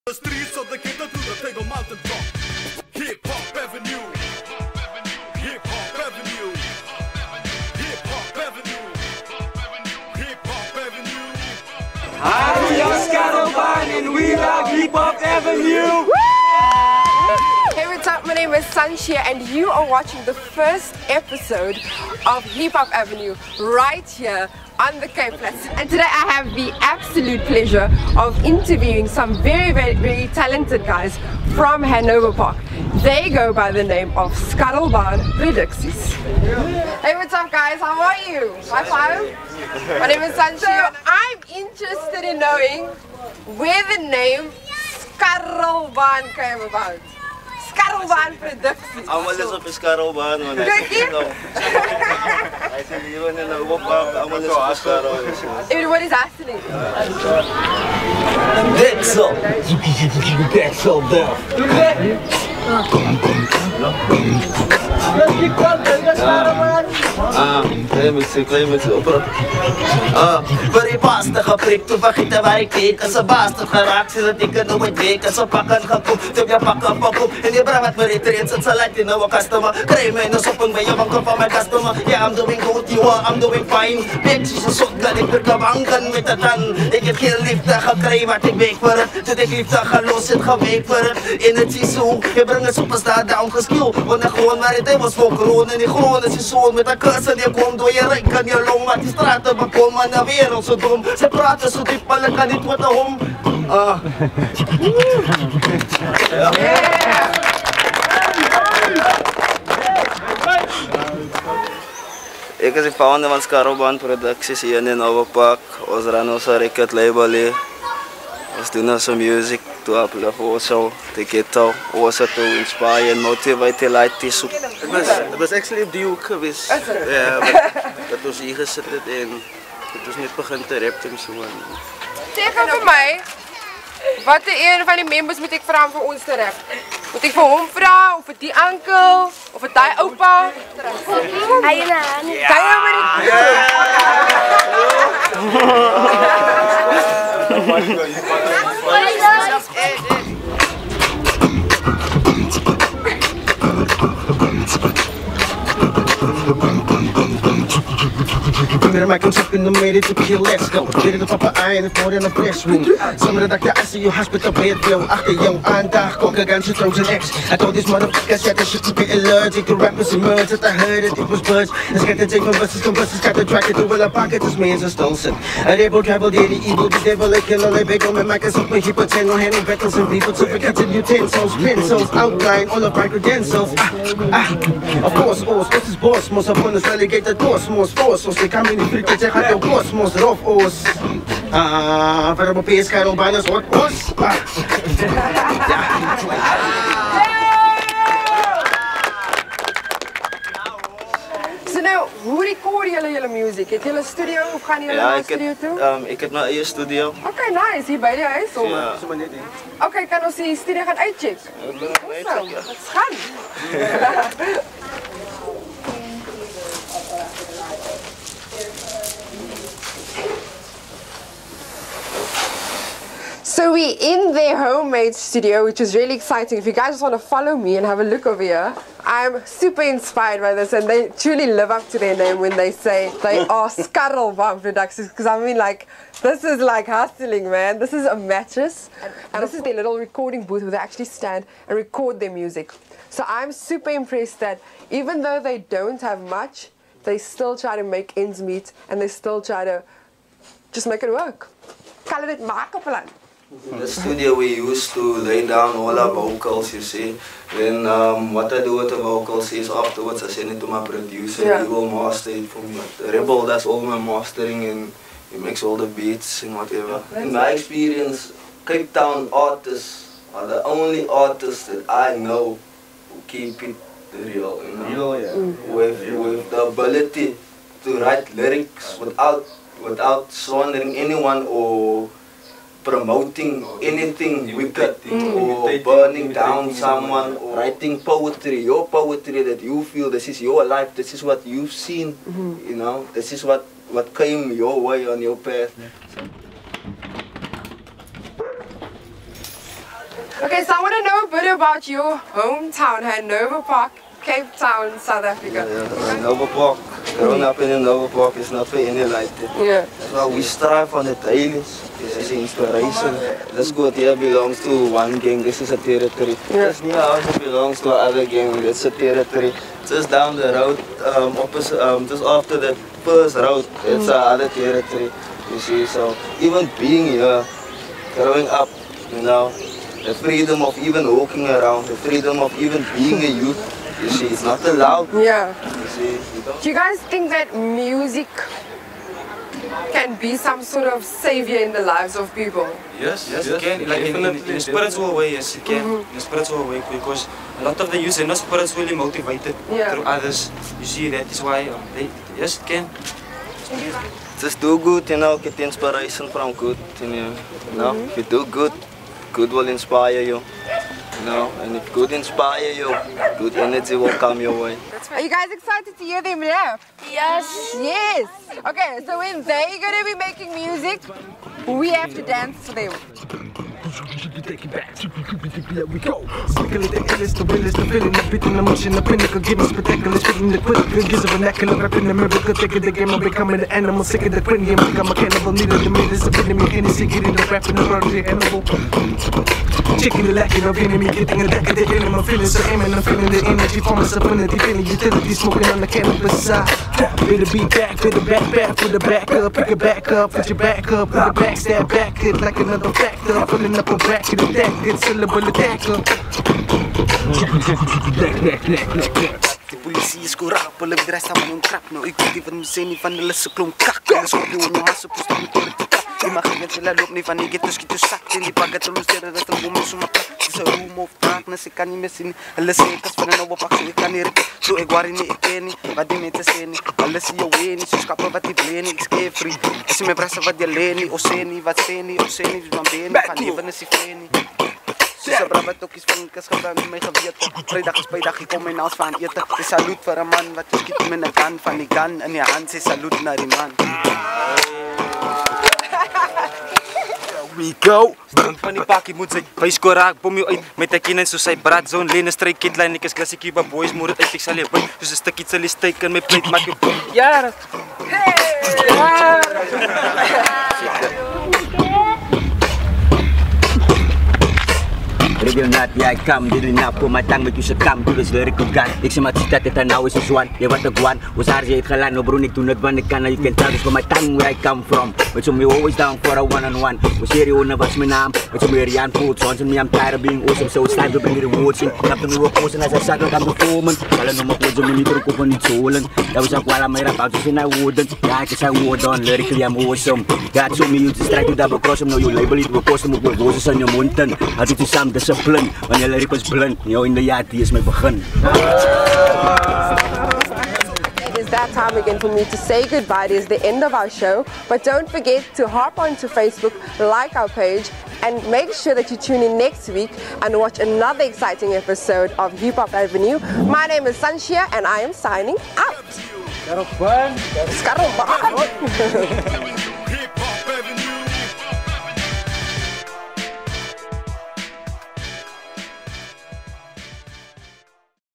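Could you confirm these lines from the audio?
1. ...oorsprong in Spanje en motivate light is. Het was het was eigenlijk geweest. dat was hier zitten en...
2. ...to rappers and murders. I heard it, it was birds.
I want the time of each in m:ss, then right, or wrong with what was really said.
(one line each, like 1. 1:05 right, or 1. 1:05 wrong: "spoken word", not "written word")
1. 2:01 right
2. 2:49 right.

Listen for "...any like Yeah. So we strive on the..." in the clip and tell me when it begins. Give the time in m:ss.
5:08.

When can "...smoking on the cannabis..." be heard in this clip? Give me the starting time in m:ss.
6:35.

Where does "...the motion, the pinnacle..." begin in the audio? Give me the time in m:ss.
6:18.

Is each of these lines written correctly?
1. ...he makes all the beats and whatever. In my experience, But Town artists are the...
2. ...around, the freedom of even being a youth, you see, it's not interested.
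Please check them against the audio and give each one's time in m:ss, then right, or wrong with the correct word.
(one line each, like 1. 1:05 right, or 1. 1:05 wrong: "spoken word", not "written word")
1. 4:25 wrong: "Cape", not "But"
2. 5:31 wrong: "allowed", not "interested".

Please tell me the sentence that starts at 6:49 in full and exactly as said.
Polisie skorap, hulle bedreig saam met 'n krap nou.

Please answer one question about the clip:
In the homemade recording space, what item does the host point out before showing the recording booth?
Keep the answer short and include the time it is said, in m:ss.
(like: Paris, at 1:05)
a mattress, at 3:58.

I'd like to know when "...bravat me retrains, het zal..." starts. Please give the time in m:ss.
1:17.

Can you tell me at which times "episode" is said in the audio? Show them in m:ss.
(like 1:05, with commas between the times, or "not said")
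0:21, 8:31.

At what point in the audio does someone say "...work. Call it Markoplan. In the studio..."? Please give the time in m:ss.
4:11.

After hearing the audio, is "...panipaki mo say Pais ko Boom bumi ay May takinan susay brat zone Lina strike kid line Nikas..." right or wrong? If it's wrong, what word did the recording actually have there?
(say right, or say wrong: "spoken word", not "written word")
right.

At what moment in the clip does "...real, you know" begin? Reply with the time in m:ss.
4:34.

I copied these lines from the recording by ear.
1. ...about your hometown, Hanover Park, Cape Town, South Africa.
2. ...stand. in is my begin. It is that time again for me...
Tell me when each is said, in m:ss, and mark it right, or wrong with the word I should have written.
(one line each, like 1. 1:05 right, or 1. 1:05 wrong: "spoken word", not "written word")
1. 5:01 right
2. 8:15 wrong: "blind", not "stand".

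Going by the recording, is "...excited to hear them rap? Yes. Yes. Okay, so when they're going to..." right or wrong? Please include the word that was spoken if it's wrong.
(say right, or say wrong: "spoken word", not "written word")
right.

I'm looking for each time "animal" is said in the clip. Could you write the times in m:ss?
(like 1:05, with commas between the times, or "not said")
6:23, 6:28.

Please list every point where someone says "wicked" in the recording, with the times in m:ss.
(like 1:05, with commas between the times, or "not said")
4:44.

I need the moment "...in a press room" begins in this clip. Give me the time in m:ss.
2:42.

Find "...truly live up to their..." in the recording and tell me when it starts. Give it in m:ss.
3:51.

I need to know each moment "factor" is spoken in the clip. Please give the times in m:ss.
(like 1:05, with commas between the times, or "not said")
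6:42.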